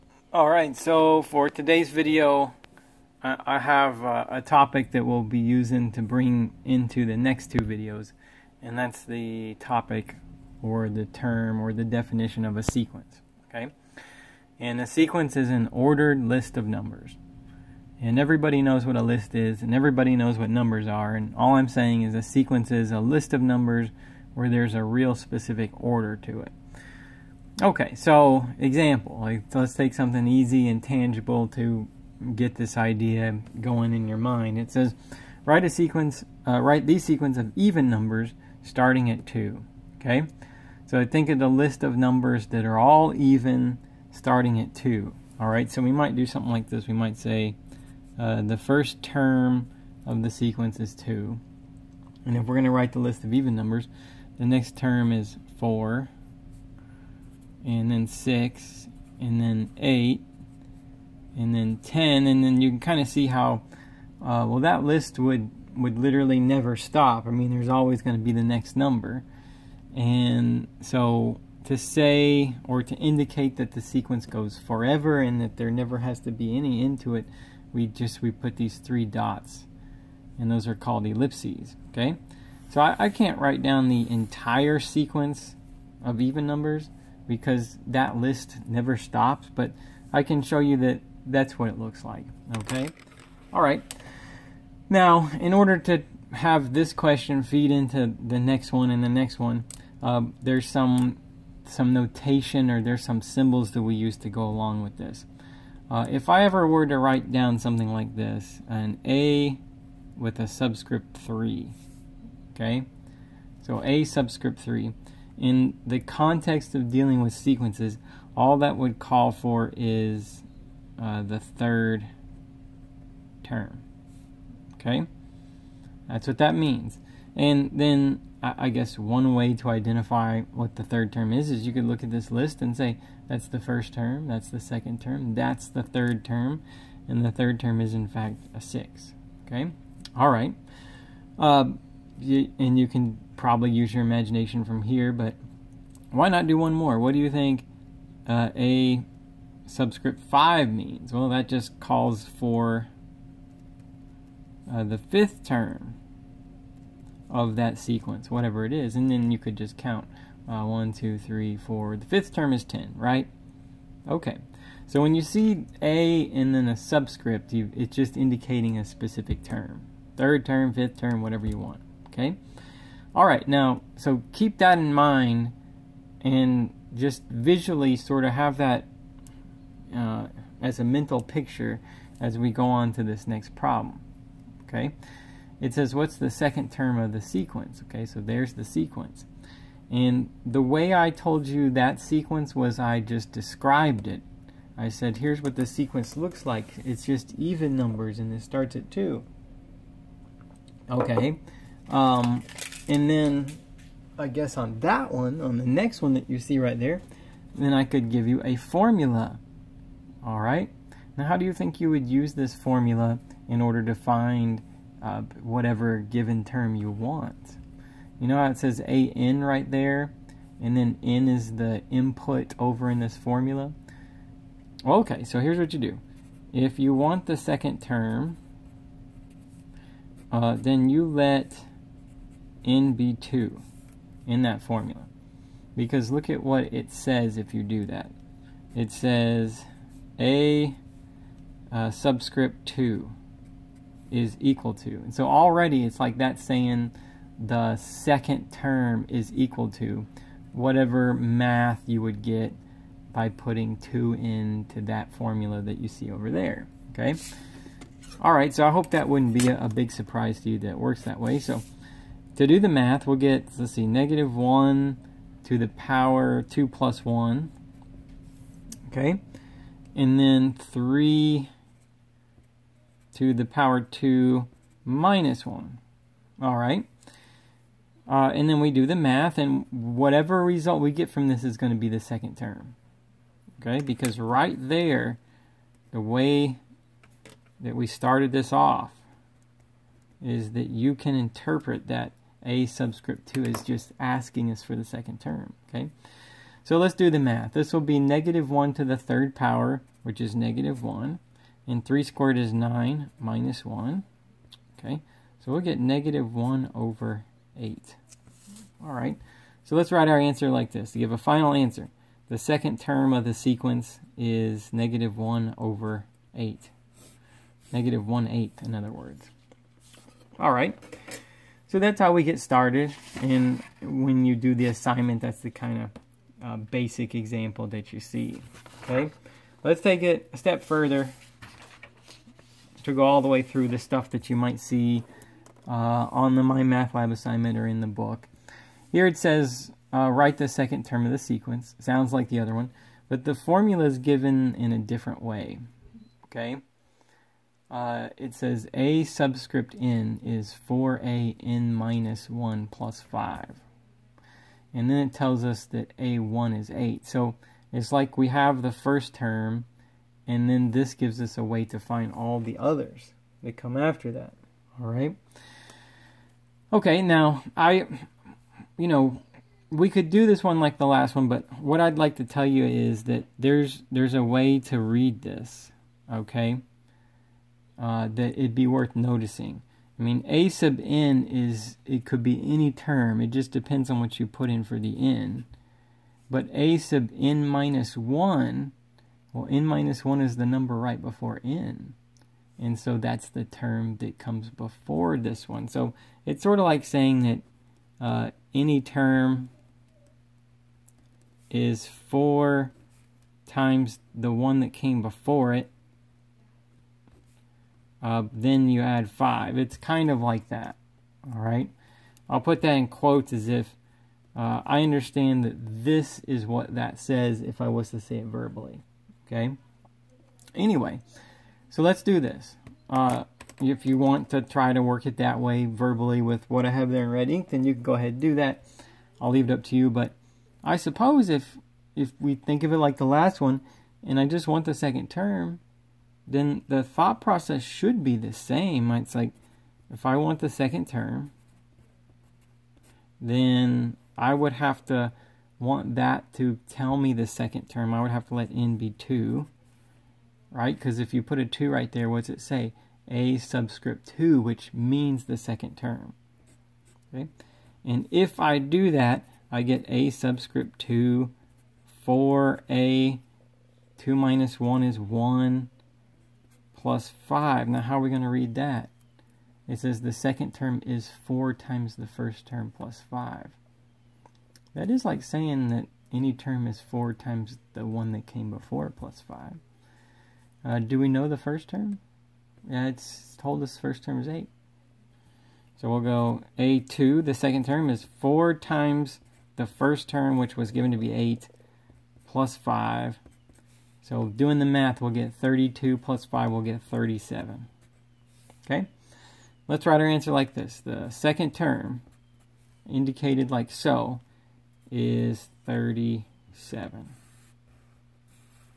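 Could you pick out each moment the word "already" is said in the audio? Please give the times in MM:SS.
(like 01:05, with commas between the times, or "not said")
04:05.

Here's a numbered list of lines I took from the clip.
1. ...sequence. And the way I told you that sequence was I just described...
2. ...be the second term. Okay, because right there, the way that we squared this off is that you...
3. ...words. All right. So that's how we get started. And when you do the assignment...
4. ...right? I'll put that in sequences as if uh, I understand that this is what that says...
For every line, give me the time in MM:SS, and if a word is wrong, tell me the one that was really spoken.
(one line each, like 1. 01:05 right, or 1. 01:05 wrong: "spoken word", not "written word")
1. 03:08 right
2. 04:41 wrong: "started", not "squared"
3. 05:18 right
4. 06:51 wrong: "quotes", not "sequences".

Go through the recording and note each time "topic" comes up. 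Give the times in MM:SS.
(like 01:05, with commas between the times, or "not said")
00:04, 00:09.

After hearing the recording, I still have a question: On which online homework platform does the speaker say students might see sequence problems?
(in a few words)
My Math Lab.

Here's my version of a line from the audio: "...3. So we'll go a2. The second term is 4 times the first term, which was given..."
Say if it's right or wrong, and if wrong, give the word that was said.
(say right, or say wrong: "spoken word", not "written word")
wrong: "8", not "3".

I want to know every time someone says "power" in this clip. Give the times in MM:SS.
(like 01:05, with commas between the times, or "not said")
04:25, 04:33, 04:59.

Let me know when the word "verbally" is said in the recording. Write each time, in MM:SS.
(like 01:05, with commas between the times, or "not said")
06:58, 07:05.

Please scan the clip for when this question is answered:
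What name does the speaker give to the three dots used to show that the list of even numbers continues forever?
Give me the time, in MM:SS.
01:21.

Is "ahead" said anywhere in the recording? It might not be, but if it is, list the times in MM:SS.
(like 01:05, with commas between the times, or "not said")
07:07.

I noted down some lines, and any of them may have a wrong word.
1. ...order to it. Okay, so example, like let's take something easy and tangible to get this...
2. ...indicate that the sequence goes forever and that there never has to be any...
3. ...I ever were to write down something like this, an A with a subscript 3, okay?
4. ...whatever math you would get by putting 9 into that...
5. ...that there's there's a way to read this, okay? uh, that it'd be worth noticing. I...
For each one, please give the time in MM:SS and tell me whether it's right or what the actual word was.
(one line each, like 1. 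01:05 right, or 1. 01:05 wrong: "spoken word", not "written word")
1. 00:25 right
2. 01:12 right
3. 01:46 right
4. 04:10 wrong: "2", not "9"
5. 06:13 right.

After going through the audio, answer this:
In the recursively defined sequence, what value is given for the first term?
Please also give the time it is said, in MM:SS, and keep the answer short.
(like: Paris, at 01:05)
8, at 05:55.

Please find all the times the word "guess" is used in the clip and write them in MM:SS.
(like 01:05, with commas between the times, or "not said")
02:08, 03:24.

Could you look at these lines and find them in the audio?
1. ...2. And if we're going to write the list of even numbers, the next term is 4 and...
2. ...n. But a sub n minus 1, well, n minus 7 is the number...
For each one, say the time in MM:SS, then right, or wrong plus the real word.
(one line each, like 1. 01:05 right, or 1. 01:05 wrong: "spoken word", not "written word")
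1. 00:50 right
2. 06:24 wrong: "1", not "7".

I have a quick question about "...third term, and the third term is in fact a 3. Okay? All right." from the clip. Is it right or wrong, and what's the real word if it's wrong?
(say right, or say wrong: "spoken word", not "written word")
wrong: "6", not "3".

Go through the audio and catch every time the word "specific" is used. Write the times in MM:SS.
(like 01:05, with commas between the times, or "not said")
00:25, 02:48.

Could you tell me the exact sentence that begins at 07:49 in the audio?
It says the second term is 4 times the first term plus 5.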